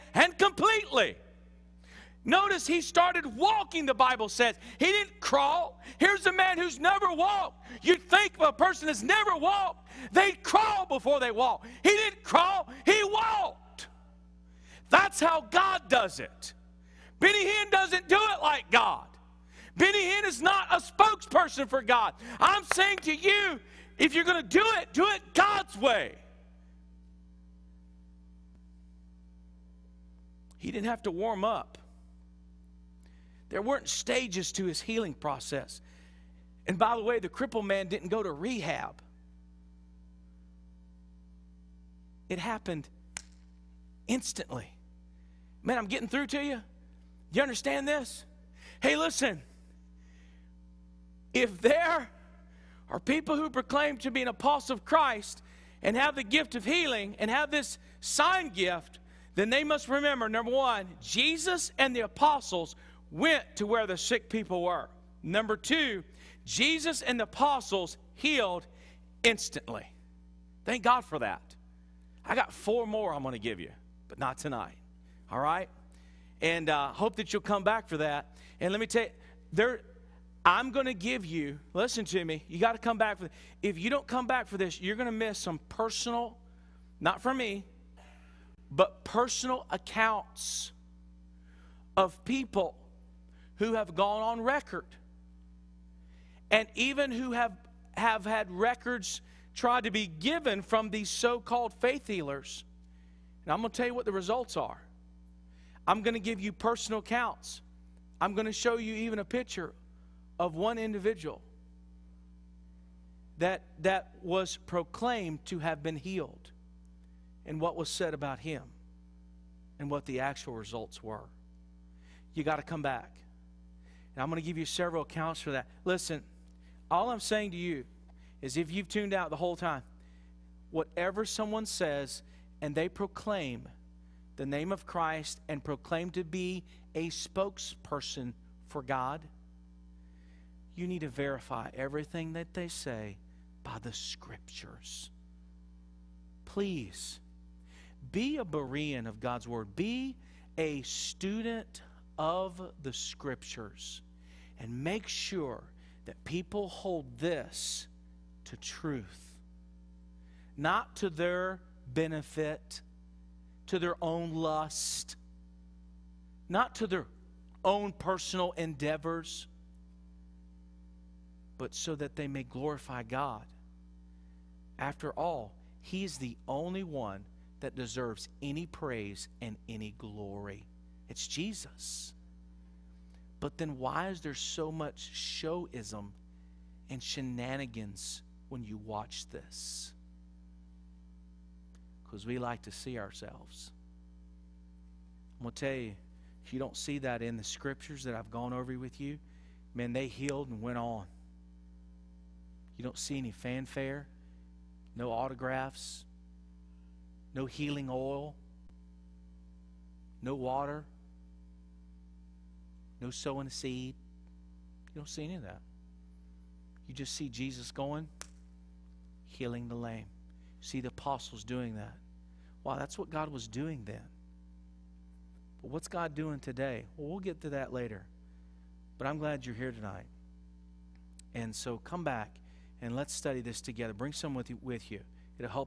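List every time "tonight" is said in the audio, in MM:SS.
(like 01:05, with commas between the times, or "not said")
01:14, 03:49.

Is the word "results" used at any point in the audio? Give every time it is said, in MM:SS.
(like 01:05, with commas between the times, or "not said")
01:44, 02:00.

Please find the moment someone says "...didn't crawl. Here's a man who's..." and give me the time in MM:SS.
00:04.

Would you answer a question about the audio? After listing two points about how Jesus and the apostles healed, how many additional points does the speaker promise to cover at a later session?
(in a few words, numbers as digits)
4.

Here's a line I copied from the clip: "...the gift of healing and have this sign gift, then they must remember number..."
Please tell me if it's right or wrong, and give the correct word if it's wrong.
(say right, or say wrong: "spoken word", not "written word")
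right.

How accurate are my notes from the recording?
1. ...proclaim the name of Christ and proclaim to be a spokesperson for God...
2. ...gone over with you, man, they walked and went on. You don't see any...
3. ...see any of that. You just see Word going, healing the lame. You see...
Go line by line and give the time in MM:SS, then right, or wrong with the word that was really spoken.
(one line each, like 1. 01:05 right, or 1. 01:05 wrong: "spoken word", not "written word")
1. 02:12 right
2. 03:18 wrong: "healed", not "walked"
3. 03:35 wrong: "Jesus", not "Word".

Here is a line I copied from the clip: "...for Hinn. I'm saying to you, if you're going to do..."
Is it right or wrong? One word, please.
wrong.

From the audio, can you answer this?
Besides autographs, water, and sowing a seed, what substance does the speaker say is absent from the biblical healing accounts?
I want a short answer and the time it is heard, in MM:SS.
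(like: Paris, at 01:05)
Healing oil, at 03:27.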